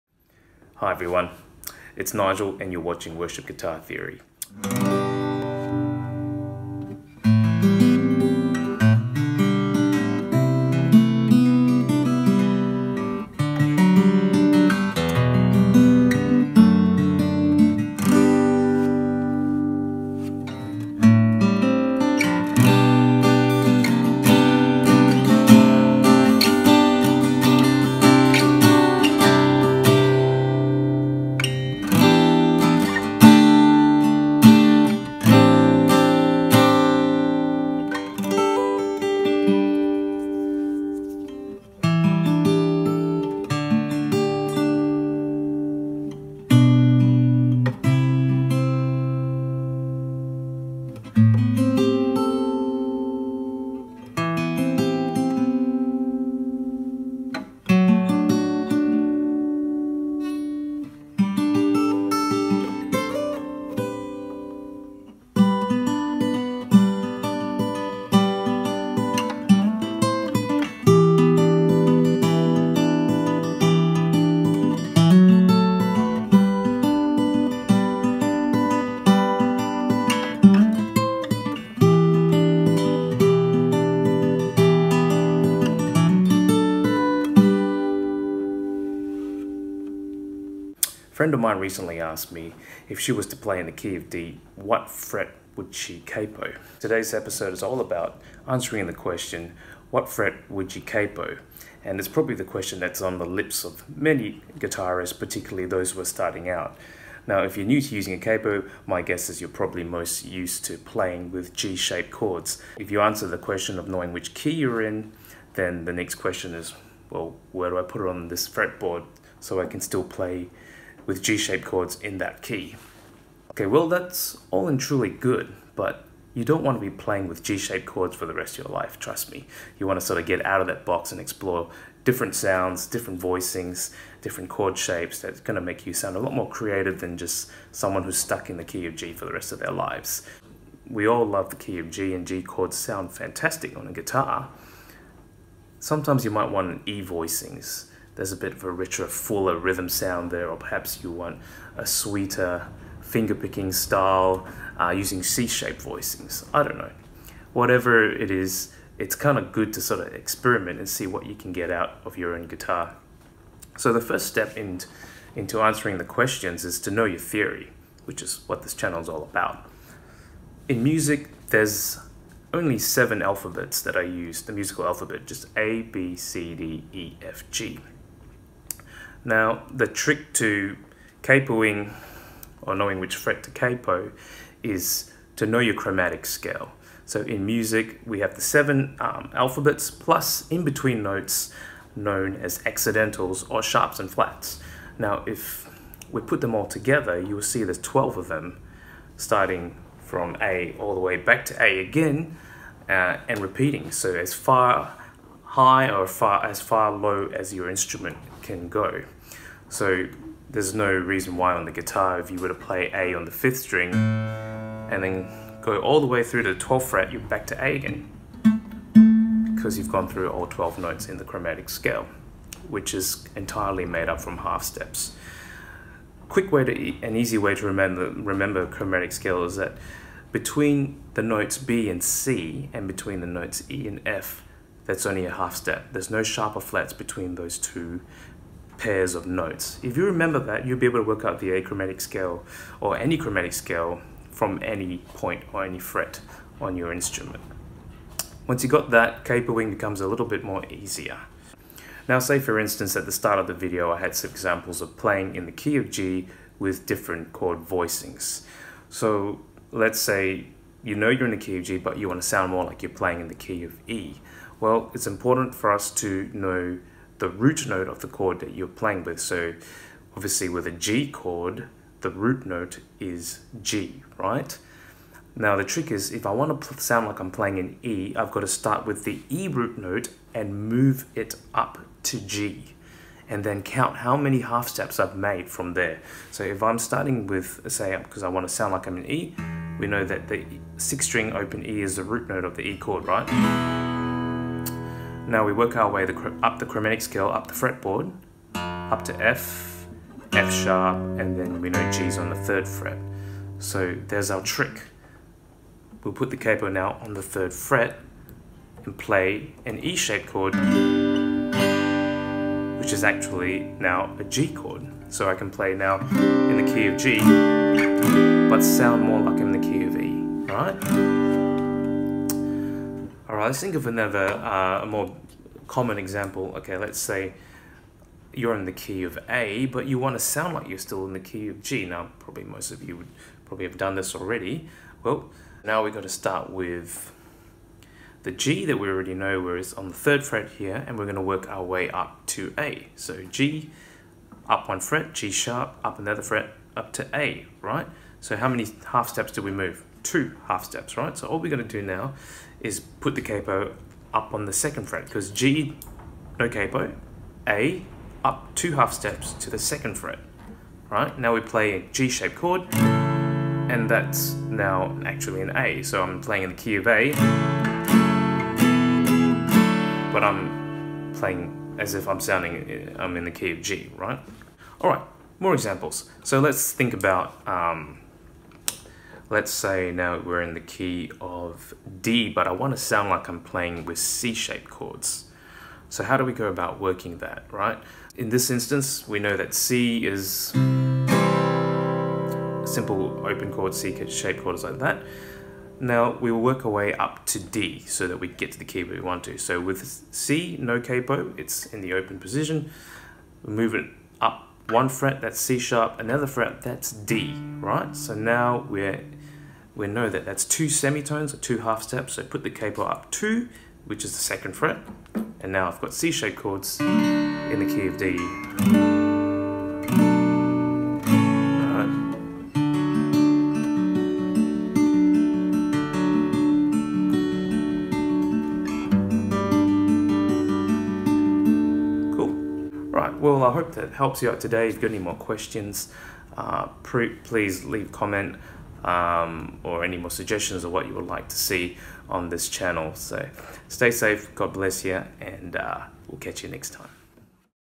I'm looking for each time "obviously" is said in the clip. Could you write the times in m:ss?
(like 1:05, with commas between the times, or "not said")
4:30.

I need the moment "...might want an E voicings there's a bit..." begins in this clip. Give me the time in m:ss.
2:26.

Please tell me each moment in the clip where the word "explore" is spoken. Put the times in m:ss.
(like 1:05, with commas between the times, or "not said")
2:11.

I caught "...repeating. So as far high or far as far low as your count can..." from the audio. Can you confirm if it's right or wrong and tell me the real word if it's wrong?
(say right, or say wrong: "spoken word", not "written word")
wrong: "instrument", not "count".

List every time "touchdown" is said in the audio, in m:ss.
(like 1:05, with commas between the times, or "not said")
not said.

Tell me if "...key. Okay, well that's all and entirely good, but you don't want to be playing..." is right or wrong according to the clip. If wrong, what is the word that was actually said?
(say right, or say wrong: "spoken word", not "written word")
wrong: "truly", not "entirely".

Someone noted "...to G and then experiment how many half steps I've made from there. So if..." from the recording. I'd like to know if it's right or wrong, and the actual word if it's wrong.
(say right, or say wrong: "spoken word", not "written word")
wrong: "count", not "experiment".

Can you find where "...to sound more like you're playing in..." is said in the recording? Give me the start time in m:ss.
4:22.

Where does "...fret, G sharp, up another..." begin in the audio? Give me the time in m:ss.
5:44.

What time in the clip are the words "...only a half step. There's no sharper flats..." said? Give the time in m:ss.
3:55.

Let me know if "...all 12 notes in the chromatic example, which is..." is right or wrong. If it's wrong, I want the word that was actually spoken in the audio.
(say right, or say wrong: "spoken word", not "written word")
wrong: "scale", not "example".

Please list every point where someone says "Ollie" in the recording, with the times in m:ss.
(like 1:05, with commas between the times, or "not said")
not said.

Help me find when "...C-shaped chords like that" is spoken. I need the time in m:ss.
6:33.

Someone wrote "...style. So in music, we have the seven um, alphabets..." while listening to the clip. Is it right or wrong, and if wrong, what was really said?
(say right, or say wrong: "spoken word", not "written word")
wrong: "scale", not "style".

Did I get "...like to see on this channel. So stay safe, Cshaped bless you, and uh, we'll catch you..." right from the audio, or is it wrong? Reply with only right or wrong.
wrong.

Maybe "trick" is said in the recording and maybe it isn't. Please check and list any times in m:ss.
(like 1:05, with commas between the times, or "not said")
2:59, 4:35, 5:04.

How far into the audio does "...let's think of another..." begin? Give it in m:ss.
5:23.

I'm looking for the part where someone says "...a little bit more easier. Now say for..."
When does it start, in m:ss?
4:10.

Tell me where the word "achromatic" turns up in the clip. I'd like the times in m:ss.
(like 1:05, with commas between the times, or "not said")
4:01.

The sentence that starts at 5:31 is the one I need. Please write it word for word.
Now, probably most of you would probably have done this already.